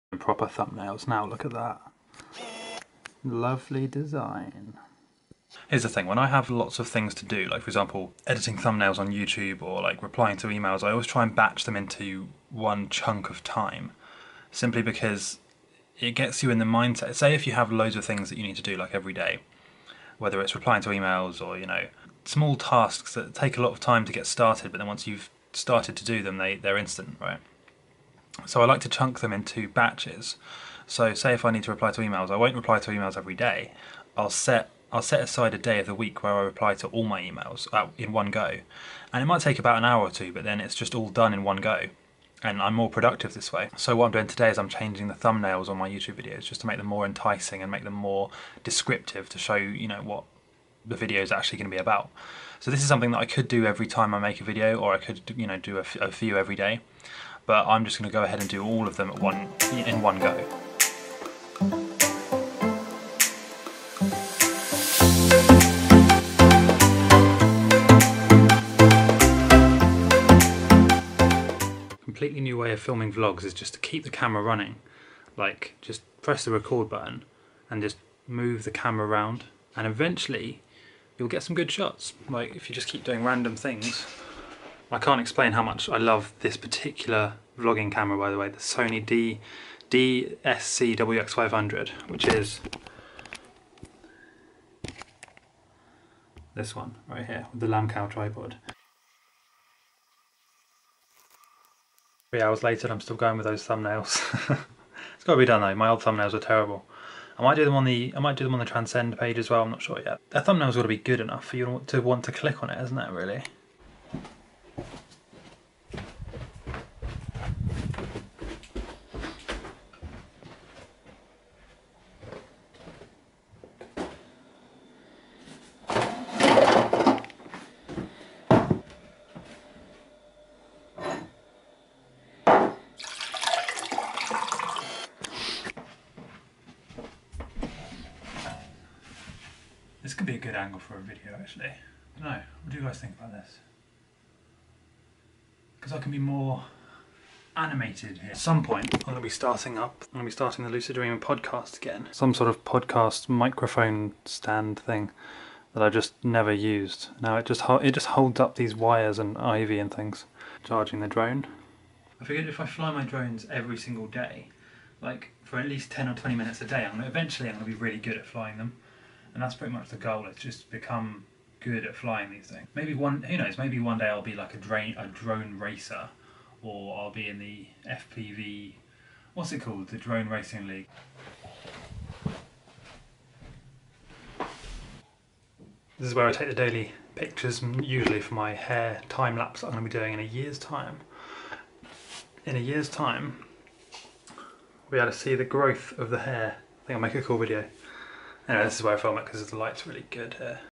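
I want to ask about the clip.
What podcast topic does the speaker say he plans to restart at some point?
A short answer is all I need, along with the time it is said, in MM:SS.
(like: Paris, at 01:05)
Lucid Dreaming, at 02:30.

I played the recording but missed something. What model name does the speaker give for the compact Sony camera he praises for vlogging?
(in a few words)
DSC-WX500.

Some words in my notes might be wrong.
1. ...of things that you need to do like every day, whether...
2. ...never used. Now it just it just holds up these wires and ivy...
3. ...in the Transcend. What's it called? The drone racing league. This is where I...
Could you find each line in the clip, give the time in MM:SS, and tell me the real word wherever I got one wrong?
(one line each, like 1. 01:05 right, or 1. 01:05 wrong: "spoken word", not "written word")
1. 00:17 right
2. 02:36 right
3. 02:57 wrong: "FPV", not "Transcend".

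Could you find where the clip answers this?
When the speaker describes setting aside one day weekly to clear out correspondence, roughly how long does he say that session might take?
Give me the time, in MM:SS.
00:39.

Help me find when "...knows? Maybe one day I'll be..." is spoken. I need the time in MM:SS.
02:53.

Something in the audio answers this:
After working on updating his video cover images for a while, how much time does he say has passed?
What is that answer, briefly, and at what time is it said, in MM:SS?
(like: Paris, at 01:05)
3 hours, at 01:42.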